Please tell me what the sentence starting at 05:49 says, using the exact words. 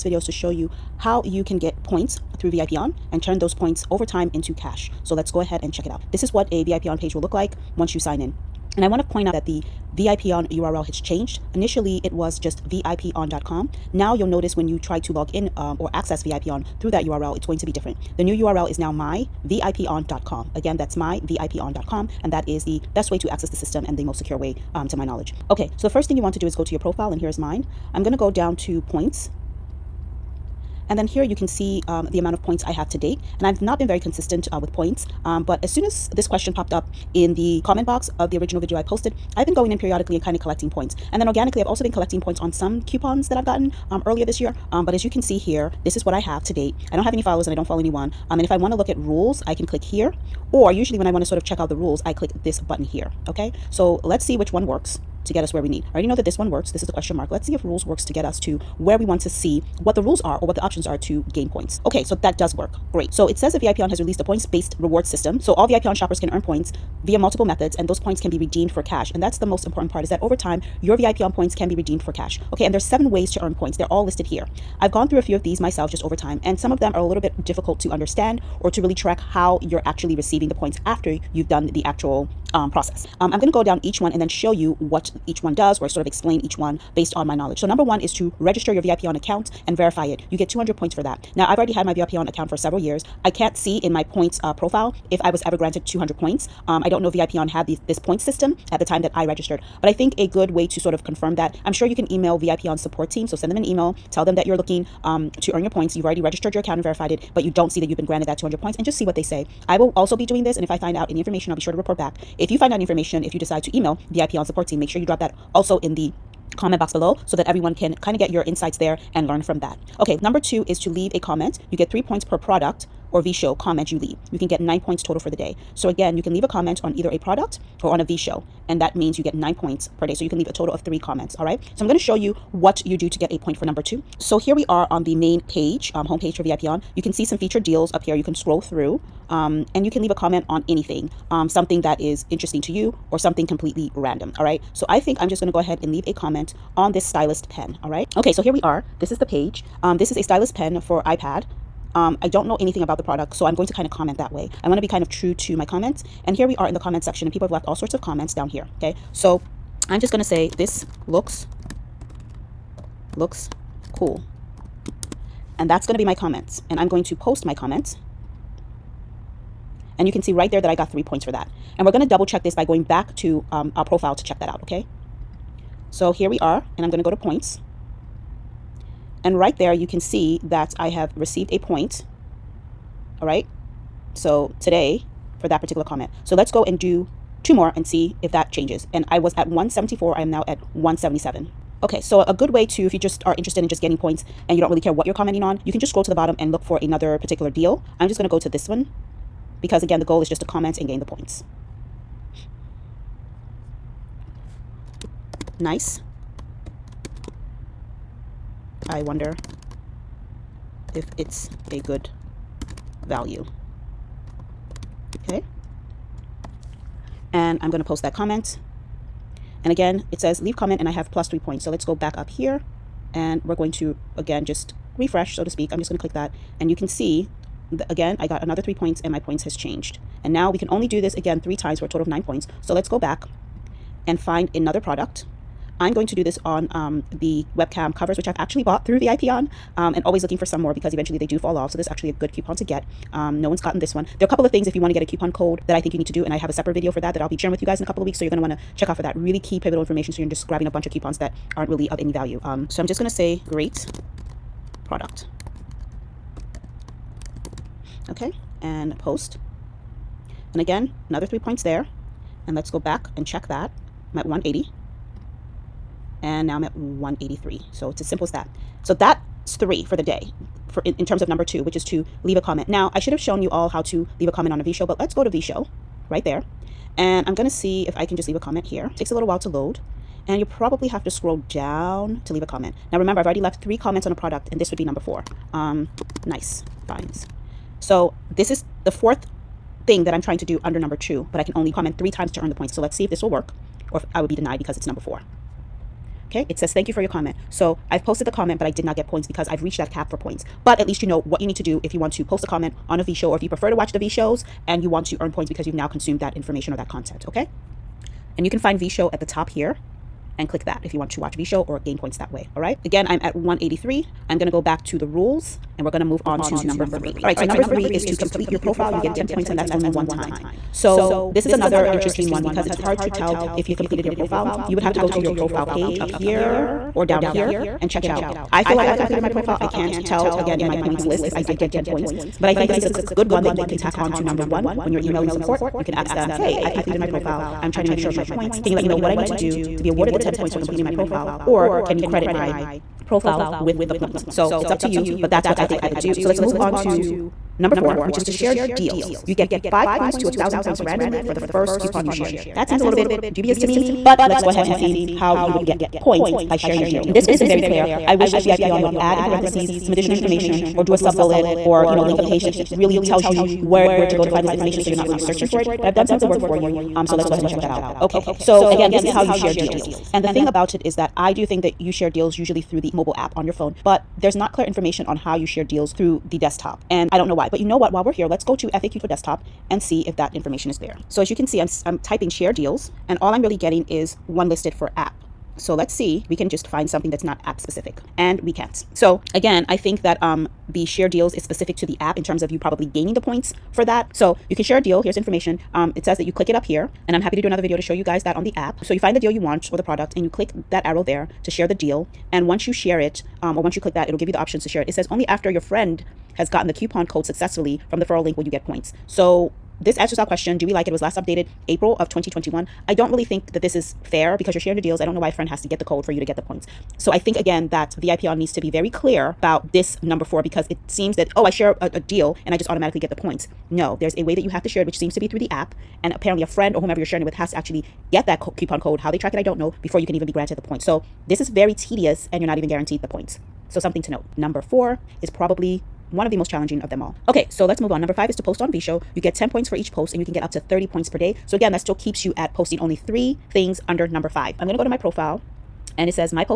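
You get five points to a thousand points randomly for the first coupon you shared.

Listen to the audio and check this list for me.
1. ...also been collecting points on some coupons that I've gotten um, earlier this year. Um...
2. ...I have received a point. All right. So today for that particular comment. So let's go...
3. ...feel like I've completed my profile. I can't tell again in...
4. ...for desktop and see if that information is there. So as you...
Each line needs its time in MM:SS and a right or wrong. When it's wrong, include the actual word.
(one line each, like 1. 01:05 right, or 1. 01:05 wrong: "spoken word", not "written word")
1. 00:41 right
2. 03:00 right
3. 05:28 right
4. 06:19 right.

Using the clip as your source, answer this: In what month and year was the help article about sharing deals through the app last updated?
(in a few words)
April 2021.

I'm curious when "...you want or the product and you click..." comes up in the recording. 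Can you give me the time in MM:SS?
06:39.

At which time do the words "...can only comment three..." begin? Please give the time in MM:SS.
04:51.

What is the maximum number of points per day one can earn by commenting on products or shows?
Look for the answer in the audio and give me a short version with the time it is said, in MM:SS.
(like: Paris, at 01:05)
9, at 02:04.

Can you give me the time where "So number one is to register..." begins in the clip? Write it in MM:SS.
01:27.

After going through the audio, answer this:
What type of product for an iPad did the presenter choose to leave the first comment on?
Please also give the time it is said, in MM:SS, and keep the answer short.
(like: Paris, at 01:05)
stylus pen, at 02:30.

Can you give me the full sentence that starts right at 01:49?
I will also be doing this, and if I find out any information, I'll be sure to report back.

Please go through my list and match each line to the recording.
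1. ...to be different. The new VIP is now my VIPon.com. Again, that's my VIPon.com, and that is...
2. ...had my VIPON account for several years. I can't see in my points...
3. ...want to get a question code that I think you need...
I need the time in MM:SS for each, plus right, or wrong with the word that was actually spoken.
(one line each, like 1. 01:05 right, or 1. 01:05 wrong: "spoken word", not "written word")
1. 00:17 wrong: "URL", not "VIP"
2. 01:31 right
3. 04:04 wrong: "coupon", not "question".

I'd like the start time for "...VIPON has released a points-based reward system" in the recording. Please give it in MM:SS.
01:03.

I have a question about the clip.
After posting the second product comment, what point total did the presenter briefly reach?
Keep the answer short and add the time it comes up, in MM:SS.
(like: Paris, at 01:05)
180, at 04:24.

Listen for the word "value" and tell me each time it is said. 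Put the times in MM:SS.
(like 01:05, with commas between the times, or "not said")
03:33, 04:12.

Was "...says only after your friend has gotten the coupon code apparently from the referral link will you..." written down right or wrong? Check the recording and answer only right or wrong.
wrong.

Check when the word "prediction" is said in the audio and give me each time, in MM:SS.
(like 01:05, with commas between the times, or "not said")
not said.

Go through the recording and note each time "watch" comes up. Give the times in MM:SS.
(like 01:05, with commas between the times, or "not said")
05:03, 05:11.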